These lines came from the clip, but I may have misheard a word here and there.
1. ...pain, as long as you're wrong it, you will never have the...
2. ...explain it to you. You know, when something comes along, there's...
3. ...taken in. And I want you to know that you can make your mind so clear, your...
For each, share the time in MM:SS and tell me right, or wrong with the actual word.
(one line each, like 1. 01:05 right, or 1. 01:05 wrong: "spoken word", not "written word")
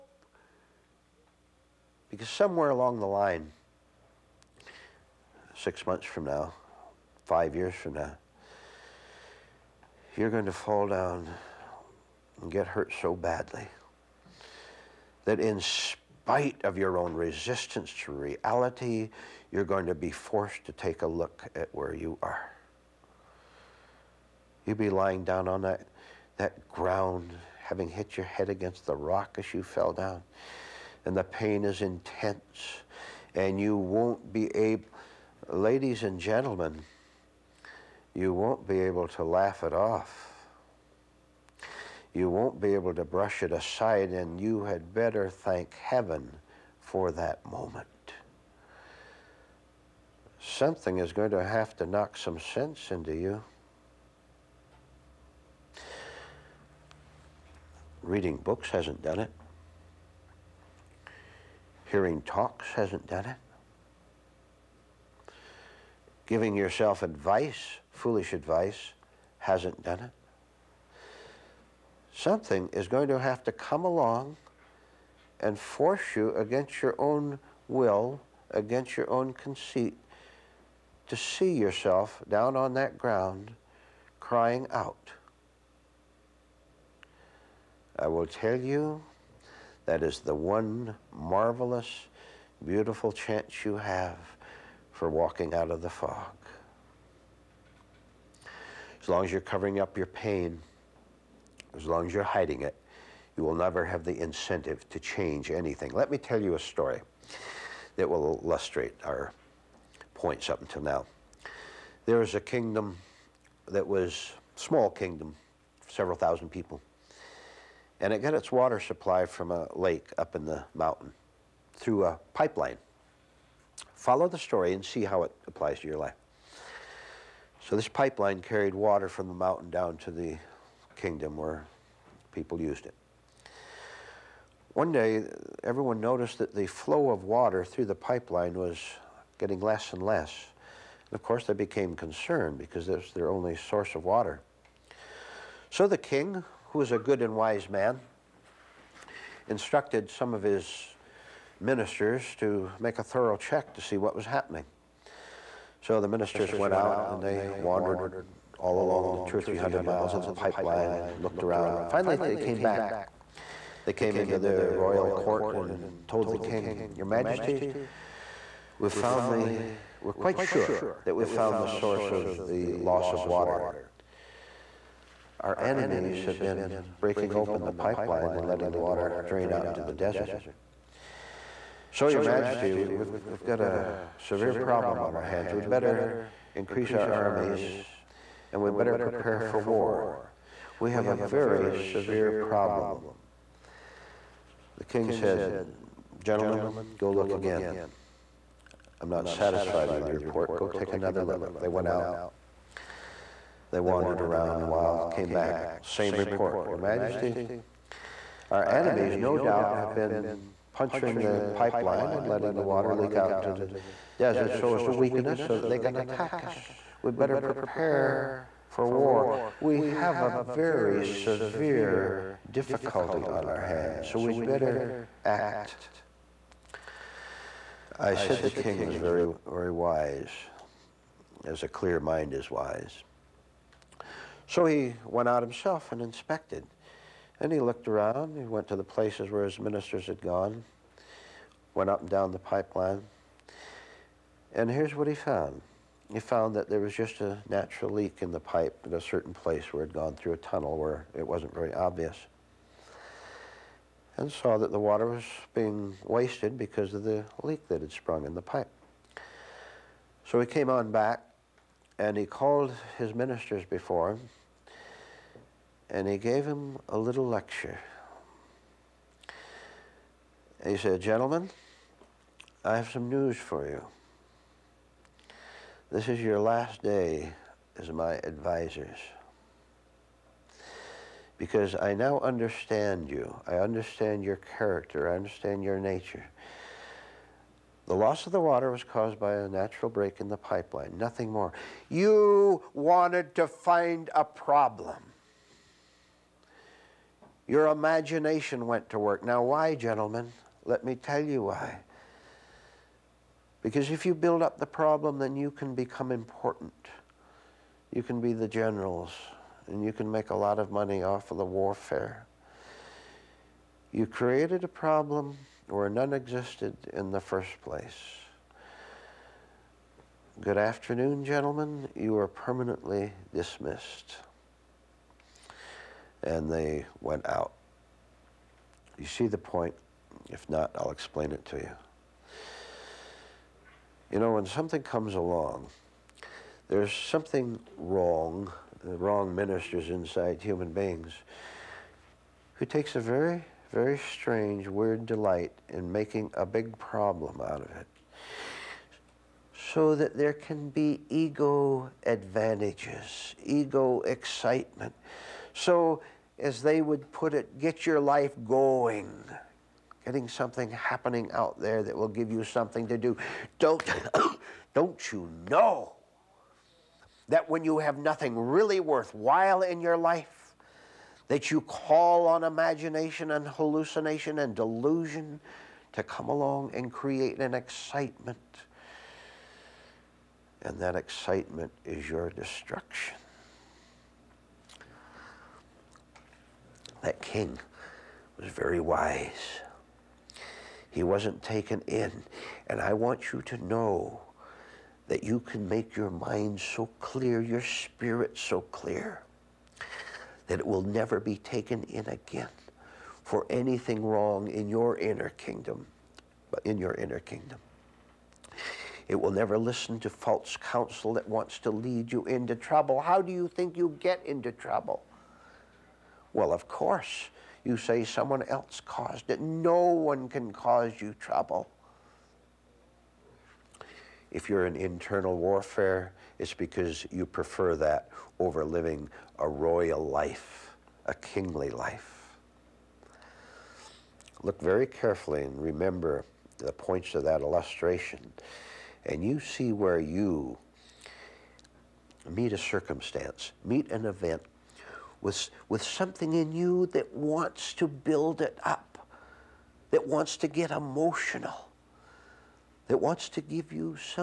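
1. 01:40 wrong: "hiding", not "wrong"
2. 05:30 right
3. 06:31 right.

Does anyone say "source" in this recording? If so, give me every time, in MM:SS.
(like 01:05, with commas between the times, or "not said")
02:23, 02:51.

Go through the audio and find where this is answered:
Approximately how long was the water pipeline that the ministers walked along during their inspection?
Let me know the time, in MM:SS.
02:39.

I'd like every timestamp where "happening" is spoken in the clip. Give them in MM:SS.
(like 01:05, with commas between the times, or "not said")
02:34, 06:00.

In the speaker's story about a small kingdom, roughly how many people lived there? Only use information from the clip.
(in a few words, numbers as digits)
several thousand.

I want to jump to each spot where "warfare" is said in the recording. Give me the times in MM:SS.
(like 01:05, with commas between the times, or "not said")
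05:11, 07:05.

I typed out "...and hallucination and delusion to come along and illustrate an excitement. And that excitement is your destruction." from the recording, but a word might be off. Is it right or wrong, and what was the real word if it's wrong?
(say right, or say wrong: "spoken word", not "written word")
wrong: "create", not "illustrate".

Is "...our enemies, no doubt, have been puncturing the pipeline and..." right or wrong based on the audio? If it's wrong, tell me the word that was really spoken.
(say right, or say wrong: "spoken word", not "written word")
right.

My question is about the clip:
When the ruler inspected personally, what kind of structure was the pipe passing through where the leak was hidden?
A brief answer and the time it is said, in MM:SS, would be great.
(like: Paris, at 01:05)
A tunnel, at 04:10.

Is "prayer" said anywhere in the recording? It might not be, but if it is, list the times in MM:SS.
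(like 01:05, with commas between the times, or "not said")
not said.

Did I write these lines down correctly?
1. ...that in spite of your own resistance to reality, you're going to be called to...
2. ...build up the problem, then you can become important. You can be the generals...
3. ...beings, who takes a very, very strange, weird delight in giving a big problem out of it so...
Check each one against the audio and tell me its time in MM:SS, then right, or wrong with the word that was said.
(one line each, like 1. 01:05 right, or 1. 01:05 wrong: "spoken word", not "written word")
1. 00:15 wrong: "forced", not "called"
2. 05:04 right
3. 05:40 wrong: "making", not "giving".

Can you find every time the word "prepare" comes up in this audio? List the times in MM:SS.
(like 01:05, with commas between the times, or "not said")
03:08, 03:37.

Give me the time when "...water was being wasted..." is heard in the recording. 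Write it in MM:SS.
04:14.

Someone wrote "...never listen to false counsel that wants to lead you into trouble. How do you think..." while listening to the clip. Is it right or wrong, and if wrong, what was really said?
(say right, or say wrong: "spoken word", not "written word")
right.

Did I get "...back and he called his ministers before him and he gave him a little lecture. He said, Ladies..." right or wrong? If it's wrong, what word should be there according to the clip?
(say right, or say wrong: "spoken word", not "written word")
wrong: "Gentlemen", not "Ladies".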